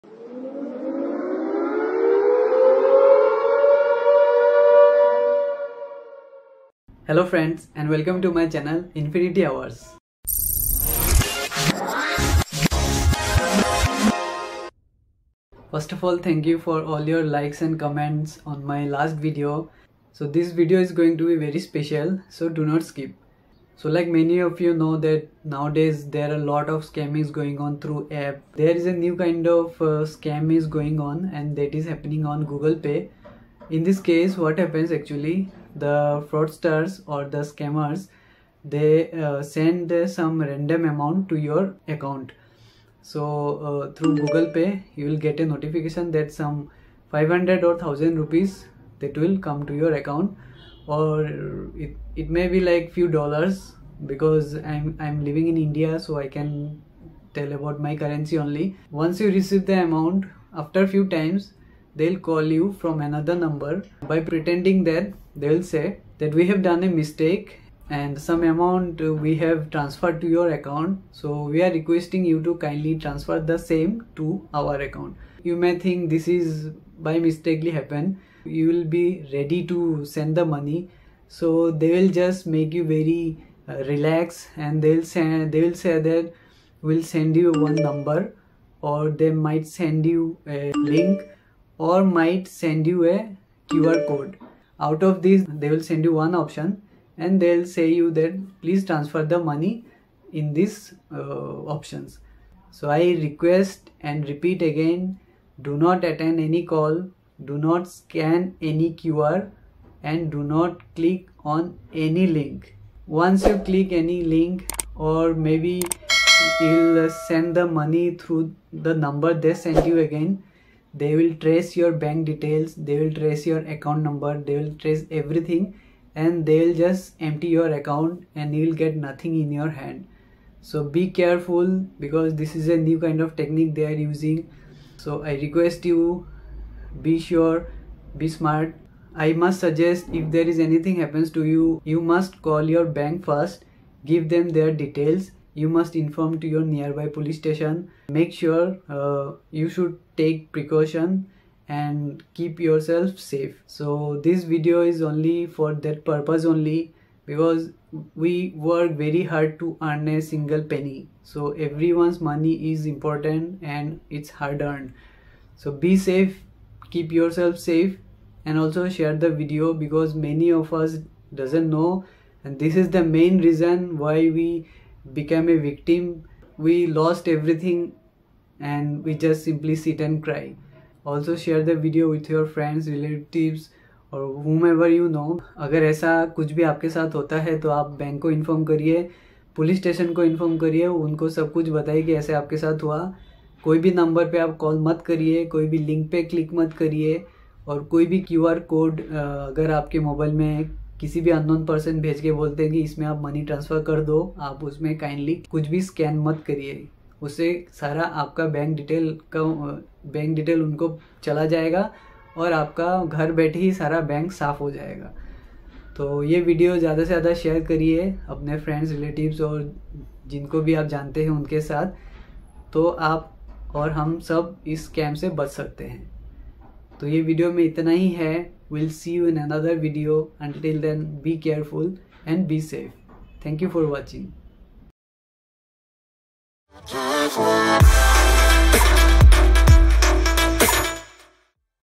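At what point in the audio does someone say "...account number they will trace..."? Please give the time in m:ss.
2:03.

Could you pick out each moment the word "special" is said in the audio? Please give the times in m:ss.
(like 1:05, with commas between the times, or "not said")
0:21.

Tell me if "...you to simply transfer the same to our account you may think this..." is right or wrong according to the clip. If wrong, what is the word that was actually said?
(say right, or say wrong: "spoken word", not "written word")
wrong: "kindly", not "simply".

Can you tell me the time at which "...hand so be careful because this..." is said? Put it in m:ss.
2:09.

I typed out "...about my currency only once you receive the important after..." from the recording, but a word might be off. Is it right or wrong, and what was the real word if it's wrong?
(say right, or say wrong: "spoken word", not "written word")
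wrong: "amount", not "important".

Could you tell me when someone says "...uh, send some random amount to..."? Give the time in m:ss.
0:39.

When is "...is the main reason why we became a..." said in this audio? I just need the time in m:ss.
2:52.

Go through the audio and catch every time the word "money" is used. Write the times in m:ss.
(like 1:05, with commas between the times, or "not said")
1:20, 1:39, 1:57, 2:42.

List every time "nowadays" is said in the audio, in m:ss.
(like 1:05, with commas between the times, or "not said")
0:25.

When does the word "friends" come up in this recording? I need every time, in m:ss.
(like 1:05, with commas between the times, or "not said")
0:07, 3:02.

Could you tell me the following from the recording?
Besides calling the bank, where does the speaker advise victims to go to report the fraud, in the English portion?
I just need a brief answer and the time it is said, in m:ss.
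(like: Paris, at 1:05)
nearby police station, at 2:26.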